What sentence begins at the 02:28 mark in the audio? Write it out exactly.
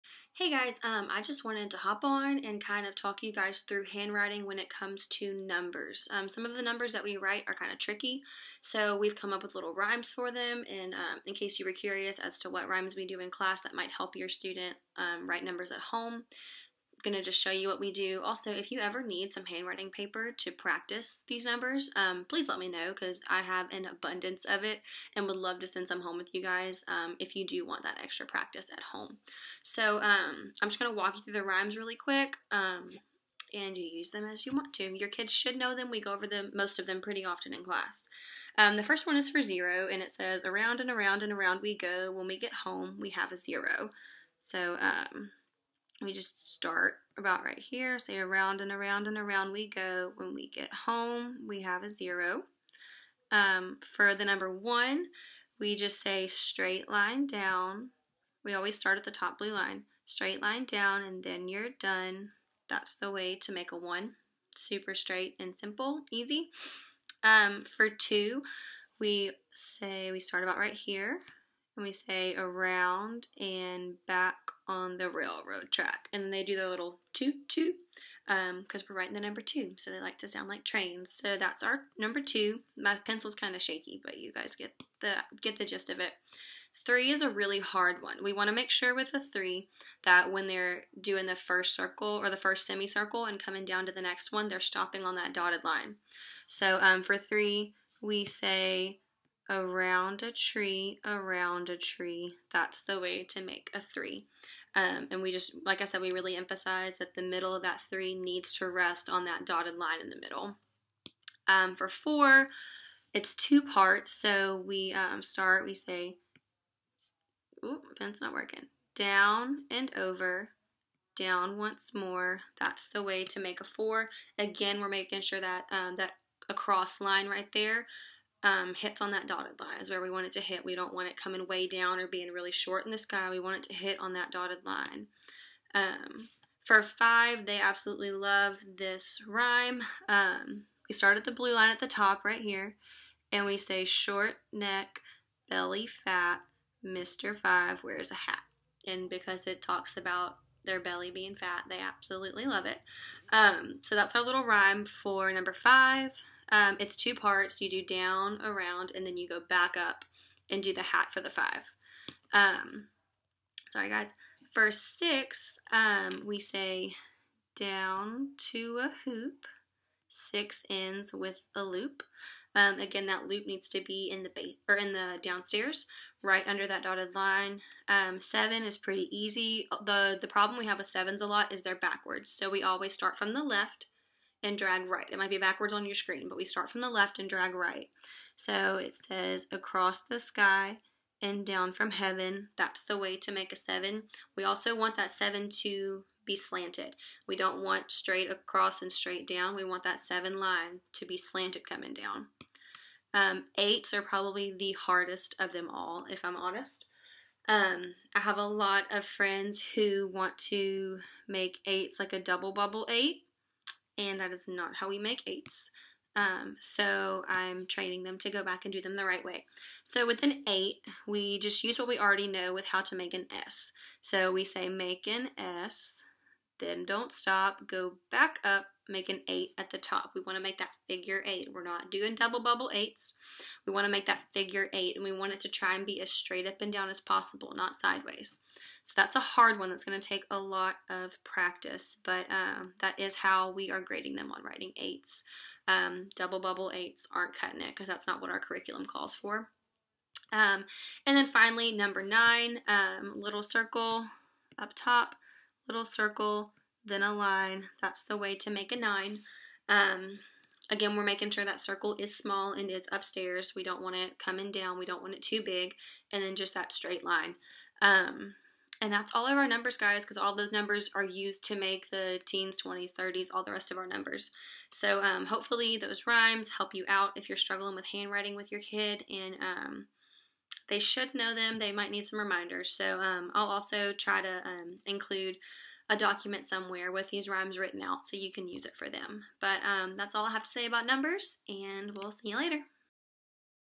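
And because it talks about their belly being fat, they absolutely love it.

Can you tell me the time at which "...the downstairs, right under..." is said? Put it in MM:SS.
02:54.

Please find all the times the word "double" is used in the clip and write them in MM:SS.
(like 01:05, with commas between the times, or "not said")
03:32, 03:52, 04:06.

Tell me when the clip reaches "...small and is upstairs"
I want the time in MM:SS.
04:22.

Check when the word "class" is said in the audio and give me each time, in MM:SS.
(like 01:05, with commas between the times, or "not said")
00:13, 00:37.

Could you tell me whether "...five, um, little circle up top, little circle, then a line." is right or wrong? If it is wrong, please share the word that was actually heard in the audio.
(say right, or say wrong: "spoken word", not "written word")
wrong: "nine", not "five".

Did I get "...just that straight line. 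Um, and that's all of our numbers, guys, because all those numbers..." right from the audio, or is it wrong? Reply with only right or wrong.
right.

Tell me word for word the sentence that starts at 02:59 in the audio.
the The problem we have with sevens a lot is they're backwards, so we always start from the left and drag right.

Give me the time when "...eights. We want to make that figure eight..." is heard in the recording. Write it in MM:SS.
03:52.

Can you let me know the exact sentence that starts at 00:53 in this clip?
Um, for the number one, we just say straight line down.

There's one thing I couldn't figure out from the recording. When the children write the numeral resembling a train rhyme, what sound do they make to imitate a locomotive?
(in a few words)
toot toot.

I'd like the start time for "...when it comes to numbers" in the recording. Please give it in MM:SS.
00:04.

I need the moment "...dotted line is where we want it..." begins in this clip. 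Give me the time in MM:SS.
02:09.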